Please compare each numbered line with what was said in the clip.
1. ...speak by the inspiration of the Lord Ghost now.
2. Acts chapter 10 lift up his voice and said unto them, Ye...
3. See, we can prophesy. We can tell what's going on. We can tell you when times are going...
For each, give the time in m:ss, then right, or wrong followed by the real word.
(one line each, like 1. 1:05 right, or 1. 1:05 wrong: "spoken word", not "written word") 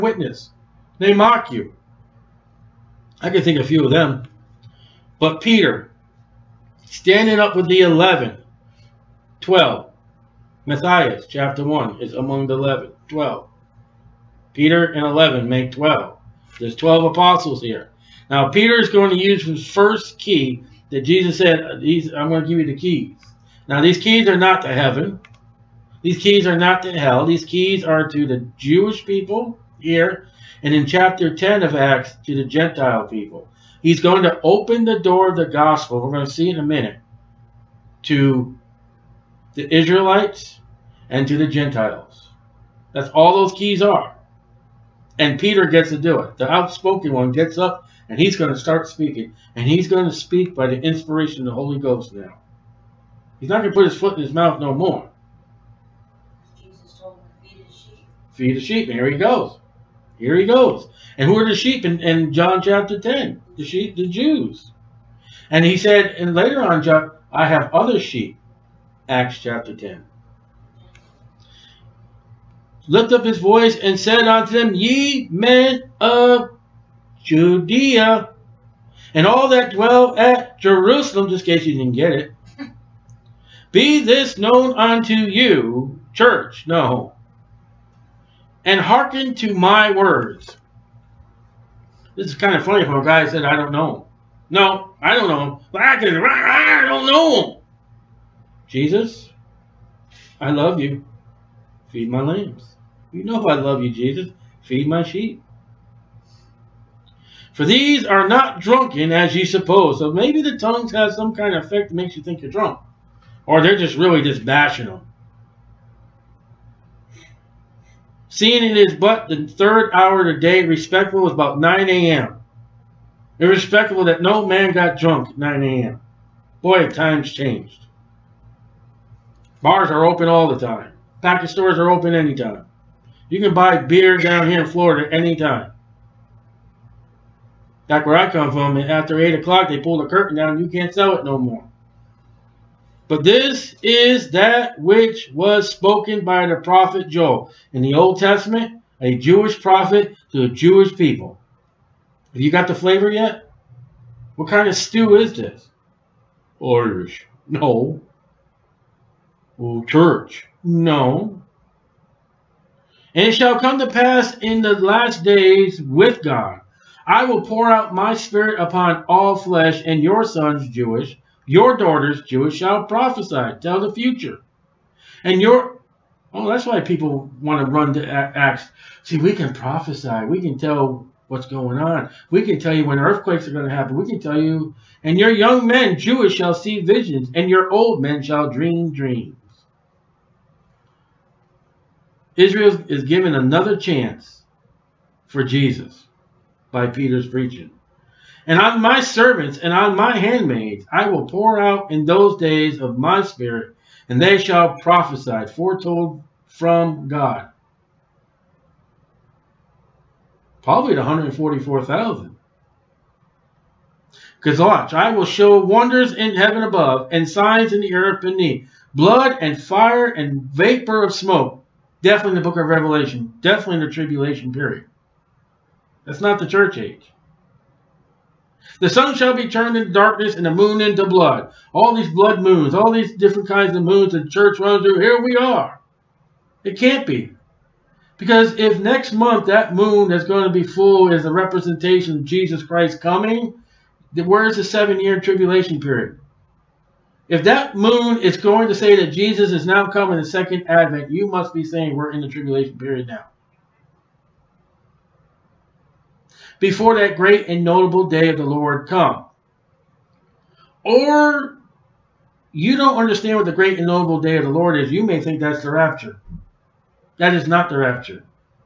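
1. 0:50 wrong: "Holy", not "Lord"
2. 1:09 right
3. 2:59 wrong: "earthquakes", not "times".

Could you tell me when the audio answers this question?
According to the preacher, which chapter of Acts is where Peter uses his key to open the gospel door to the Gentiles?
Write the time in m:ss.
0:31.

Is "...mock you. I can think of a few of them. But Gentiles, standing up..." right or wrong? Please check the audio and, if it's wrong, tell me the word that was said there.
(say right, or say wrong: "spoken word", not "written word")
wrong: "Peter", not "Gentiles".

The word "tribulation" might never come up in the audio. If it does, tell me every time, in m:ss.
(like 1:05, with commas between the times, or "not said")
3:43, 4:05, 4:12.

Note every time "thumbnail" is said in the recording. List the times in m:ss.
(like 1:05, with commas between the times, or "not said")
not said.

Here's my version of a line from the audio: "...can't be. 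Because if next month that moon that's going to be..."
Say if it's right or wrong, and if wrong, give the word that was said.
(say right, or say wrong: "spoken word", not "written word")
right.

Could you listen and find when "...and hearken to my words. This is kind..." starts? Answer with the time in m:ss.
1:28.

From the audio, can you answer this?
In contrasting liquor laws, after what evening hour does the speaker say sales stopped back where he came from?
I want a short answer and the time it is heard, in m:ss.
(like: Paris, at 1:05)
8 o'clock, at 2:19.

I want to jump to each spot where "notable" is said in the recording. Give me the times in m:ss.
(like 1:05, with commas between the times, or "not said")
4:17, 4:23.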